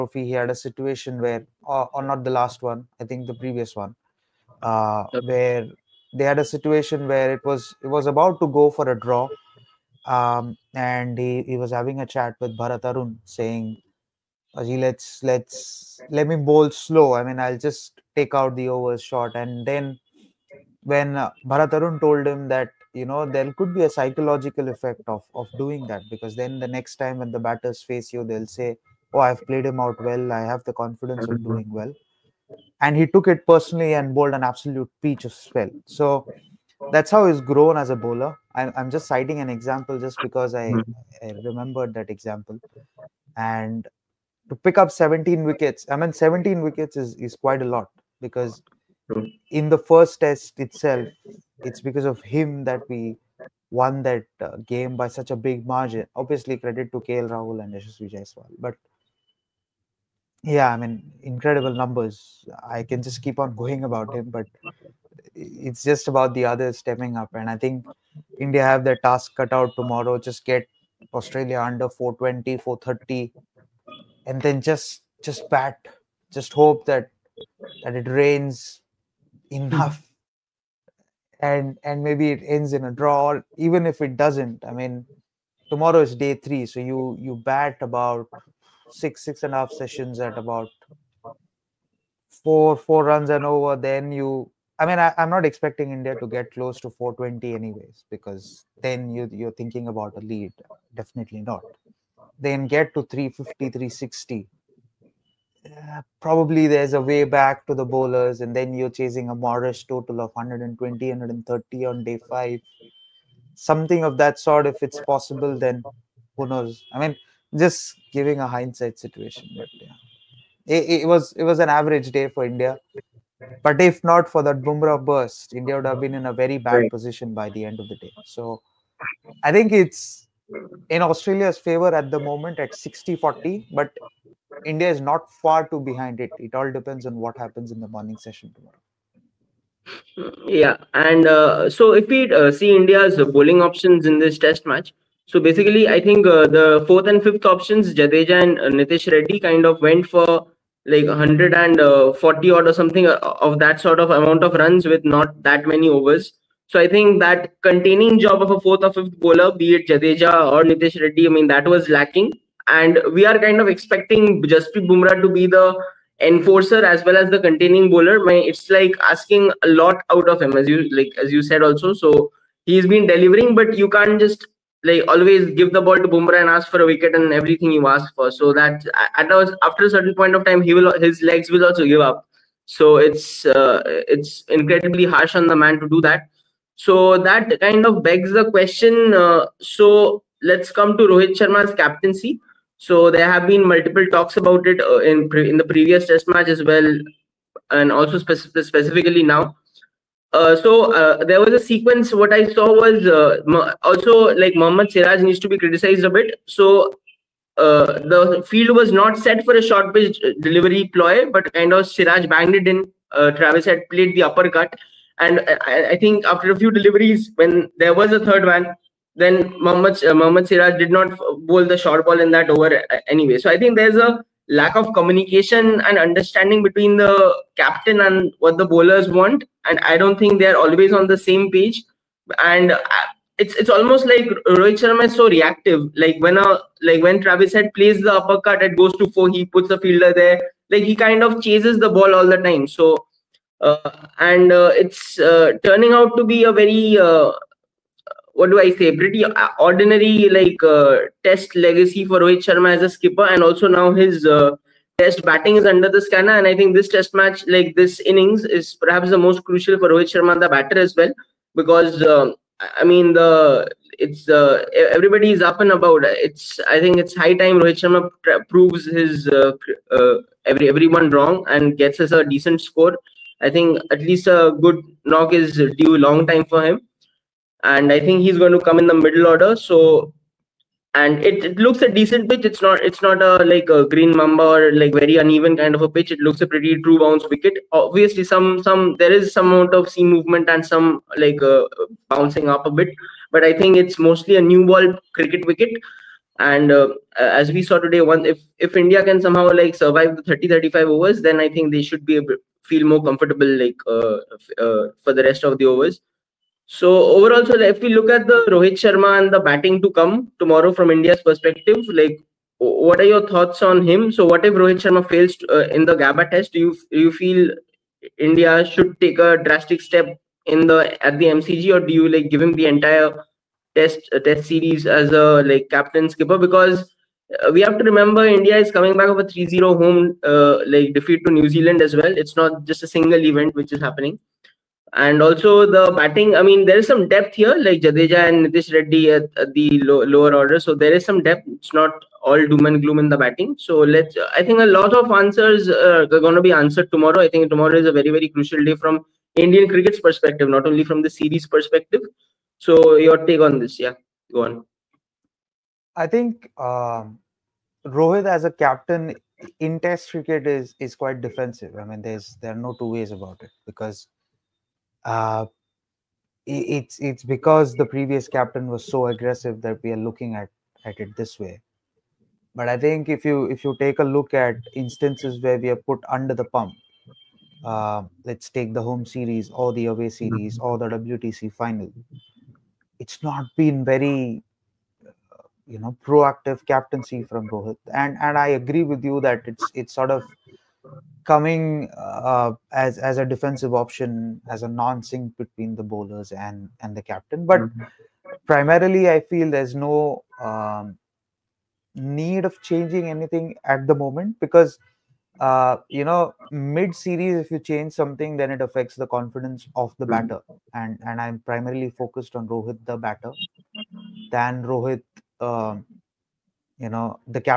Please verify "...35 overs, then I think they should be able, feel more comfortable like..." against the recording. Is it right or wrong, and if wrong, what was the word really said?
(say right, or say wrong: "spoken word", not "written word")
right.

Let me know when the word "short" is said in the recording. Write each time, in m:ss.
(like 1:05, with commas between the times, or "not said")
0:19, 3:29, 3:41.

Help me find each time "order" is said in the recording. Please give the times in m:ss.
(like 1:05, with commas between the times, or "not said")
4:39, 5:40.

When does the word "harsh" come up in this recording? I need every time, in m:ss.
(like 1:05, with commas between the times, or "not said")
3:05.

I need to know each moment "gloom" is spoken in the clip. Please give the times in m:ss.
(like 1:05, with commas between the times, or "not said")
5:42.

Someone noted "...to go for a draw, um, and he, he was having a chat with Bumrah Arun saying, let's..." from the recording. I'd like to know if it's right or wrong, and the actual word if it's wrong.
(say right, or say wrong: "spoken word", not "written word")
wrong: "Bharat", not "Bumrah".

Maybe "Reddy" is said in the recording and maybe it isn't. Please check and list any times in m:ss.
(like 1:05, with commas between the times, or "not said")
2:29, 2:41, 5:38.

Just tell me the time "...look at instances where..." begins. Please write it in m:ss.
6:14.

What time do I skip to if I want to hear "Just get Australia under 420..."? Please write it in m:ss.
1:10.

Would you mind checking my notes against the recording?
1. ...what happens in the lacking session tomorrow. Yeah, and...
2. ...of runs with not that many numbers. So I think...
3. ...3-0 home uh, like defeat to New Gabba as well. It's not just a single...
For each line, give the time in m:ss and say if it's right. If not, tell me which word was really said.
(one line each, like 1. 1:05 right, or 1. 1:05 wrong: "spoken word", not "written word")
1. 2:17 wrong: "morning", not "lacking"
2. 2:34 wrong: "overs", not "numbers"
3. 5:29 wrong: "Zealand", not "Gabba".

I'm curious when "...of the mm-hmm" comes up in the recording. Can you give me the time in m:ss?
6:49.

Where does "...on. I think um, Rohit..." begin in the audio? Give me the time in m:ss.
5:54.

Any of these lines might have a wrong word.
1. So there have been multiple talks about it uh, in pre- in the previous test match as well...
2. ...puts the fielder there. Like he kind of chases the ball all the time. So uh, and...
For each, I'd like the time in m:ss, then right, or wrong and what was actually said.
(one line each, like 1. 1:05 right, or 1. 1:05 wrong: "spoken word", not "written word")
1. 3:12 right
2. 3:59 right.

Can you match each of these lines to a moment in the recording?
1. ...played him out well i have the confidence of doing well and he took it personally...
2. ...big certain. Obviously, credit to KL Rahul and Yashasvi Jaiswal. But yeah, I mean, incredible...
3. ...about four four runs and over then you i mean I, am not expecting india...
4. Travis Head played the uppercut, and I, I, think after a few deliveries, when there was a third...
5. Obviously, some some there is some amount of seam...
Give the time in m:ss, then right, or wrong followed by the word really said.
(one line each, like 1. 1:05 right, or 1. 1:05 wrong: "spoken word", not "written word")
1. 0:29 right
2. 0:55 wrong: "margin", not "certain"
3. 1:30 right
4. 3:33 right
5. 4:47 right.